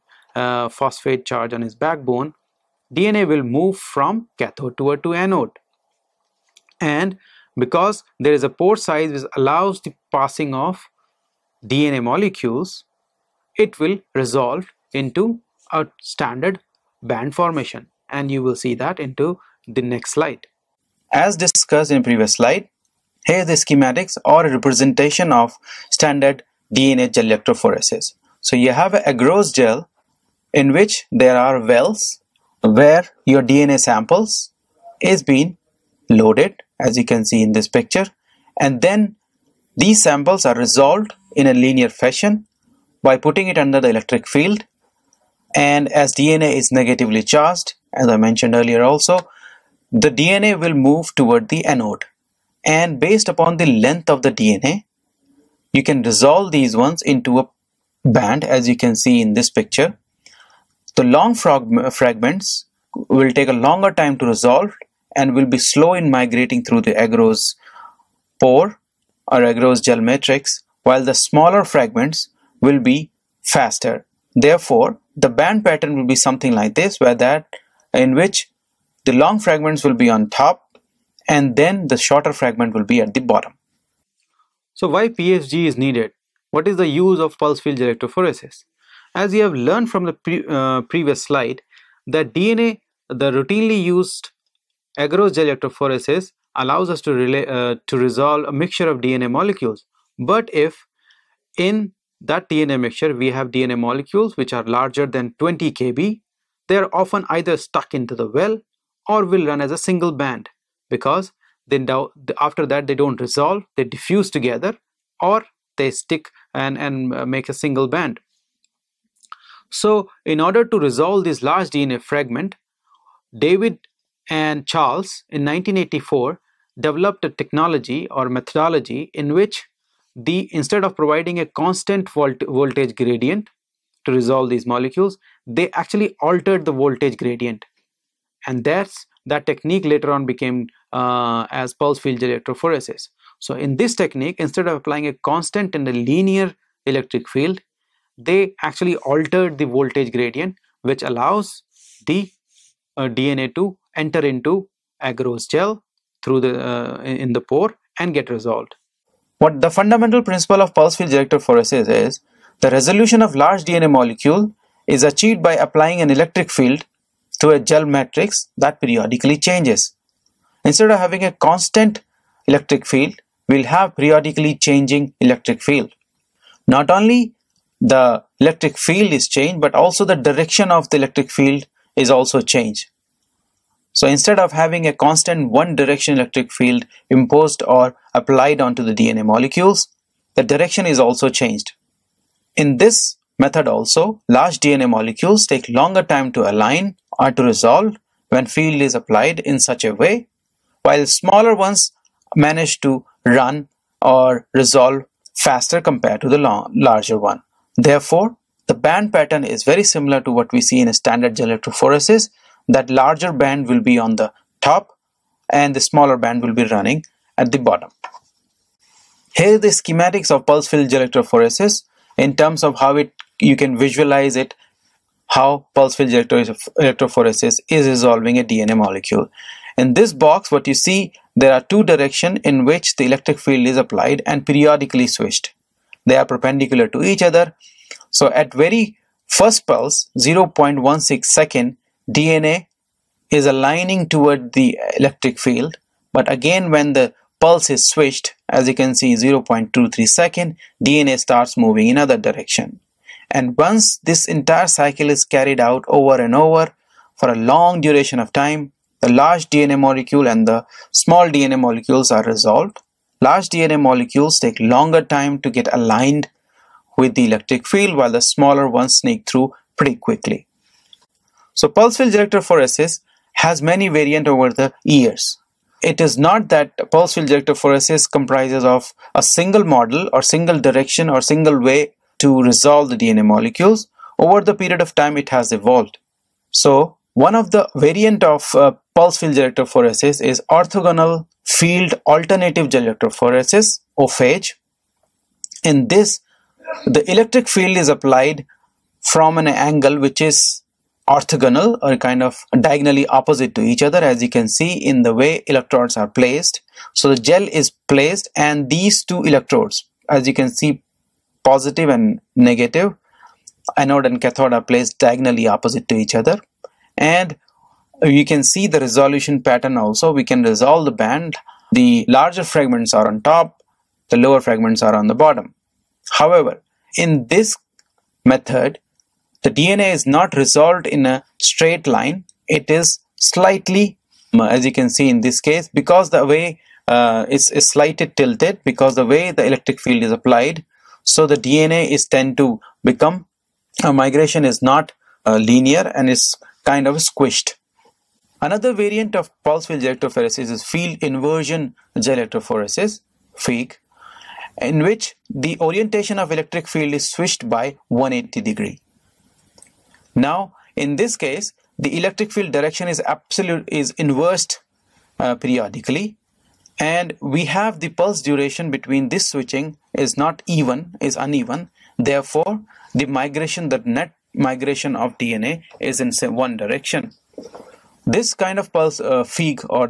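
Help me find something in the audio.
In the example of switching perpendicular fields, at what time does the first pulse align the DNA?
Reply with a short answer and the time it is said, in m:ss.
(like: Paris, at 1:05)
0.16 second, at 4:00.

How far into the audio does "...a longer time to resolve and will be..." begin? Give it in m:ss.
1:03.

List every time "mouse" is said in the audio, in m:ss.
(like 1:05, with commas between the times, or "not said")
not said.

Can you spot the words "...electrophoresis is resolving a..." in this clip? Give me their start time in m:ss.
3:46.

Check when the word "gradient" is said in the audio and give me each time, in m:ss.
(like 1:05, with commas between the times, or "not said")
2:12, 2:17, 2:30.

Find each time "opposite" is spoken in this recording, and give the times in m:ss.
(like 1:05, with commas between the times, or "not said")
5:03, 5:15.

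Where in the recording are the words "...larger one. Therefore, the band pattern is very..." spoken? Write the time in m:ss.
3:26.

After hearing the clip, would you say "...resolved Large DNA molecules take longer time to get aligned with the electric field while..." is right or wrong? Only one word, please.
right.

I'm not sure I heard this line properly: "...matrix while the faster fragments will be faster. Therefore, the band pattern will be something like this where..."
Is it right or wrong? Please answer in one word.
wrong.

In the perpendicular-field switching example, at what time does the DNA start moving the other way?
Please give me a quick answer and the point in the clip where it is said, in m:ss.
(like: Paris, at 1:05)
0.23 second, at 4:09.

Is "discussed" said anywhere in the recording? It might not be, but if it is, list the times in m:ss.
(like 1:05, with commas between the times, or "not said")
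0:21.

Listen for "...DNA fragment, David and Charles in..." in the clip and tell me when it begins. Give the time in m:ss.
2:01.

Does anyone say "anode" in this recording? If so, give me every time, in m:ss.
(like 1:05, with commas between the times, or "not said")
0:05, 0:51, 5:13.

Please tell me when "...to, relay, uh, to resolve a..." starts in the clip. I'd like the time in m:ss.
1:36.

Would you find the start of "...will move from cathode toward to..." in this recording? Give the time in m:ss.
0:03.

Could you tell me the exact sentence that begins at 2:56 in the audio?
Not only the electric field is changed but also the direction of the electric field is also changed.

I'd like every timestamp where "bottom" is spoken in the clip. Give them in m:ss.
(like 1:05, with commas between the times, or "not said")
1:23, 3:37, 5:25.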